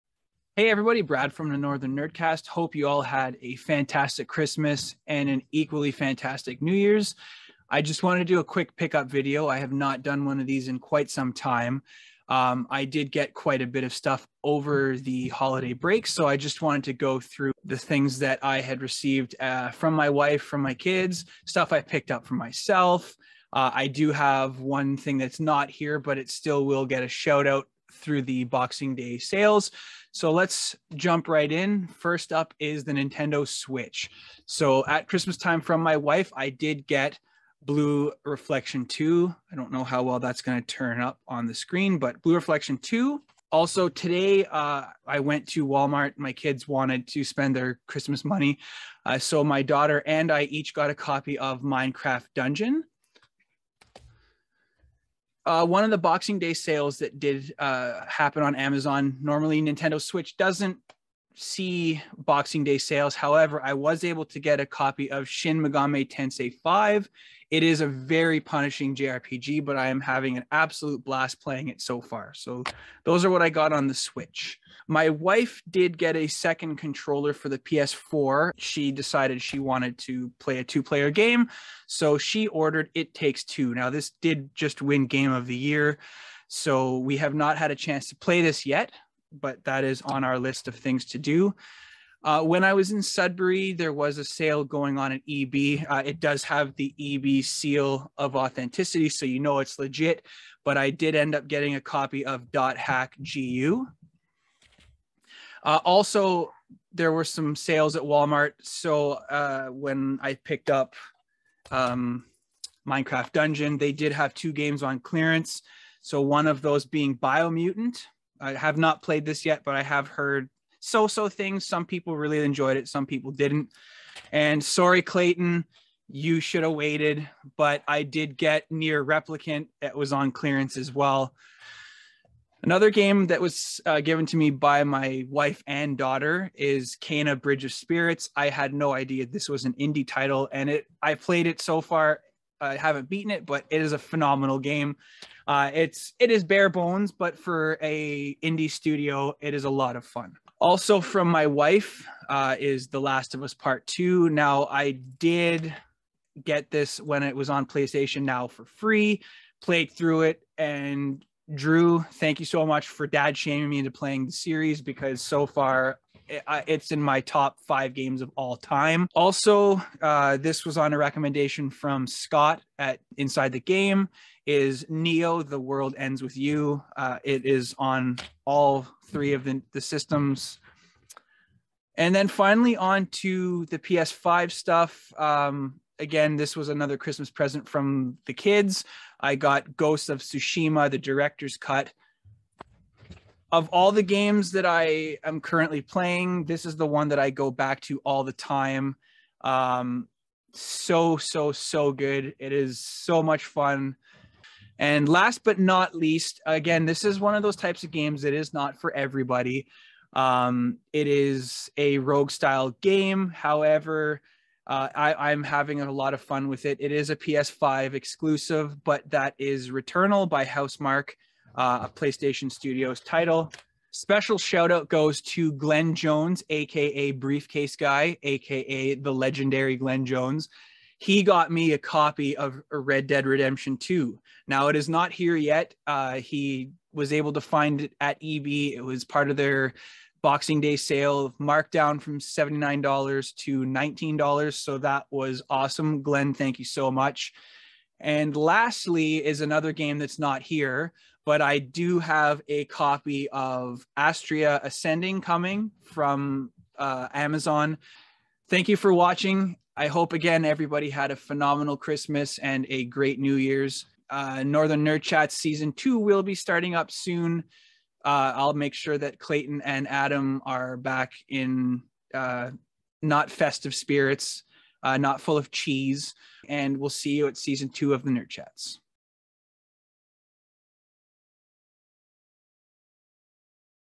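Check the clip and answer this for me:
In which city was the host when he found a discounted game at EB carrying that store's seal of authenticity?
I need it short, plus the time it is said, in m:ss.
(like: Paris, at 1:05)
Sudbury, at 1:33.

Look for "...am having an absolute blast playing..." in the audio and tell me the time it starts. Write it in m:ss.
1:09.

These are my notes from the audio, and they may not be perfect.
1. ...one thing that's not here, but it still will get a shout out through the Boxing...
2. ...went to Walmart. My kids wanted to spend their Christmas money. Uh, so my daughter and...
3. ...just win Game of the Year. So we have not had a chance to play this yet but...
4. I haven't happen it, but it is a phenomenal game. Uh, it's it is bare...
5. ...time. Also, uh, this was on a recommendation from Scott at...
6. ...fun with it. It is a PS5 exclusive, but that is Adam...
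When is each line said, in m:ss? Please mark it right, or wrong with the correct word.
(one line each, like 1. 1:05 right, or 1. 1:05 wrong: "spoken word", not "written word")
1. 0:24 right
2. 0:45 right
3. 1:24 right
4. 2:22 wrong: "beaten", not "happen"
5. 2:48 right
6. 3:36 wrong: "Returnal", not "Adam".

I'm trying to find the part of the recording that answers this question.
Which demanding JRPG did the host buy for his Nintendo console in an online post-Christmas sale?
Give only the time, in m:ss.
1:05.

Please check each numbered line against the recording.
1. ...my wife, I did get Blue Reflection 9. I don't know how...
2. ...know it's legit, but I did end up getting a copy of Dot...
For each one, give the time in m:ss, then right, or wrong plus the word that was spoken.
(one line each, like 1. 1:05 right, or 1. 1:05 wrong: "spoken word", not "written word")
1. 0:35 wrong: "2", not "9"
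2. 1:39 right.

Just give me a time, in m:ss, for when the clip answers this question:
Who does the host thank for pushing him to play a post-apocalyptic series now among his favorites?
2:41.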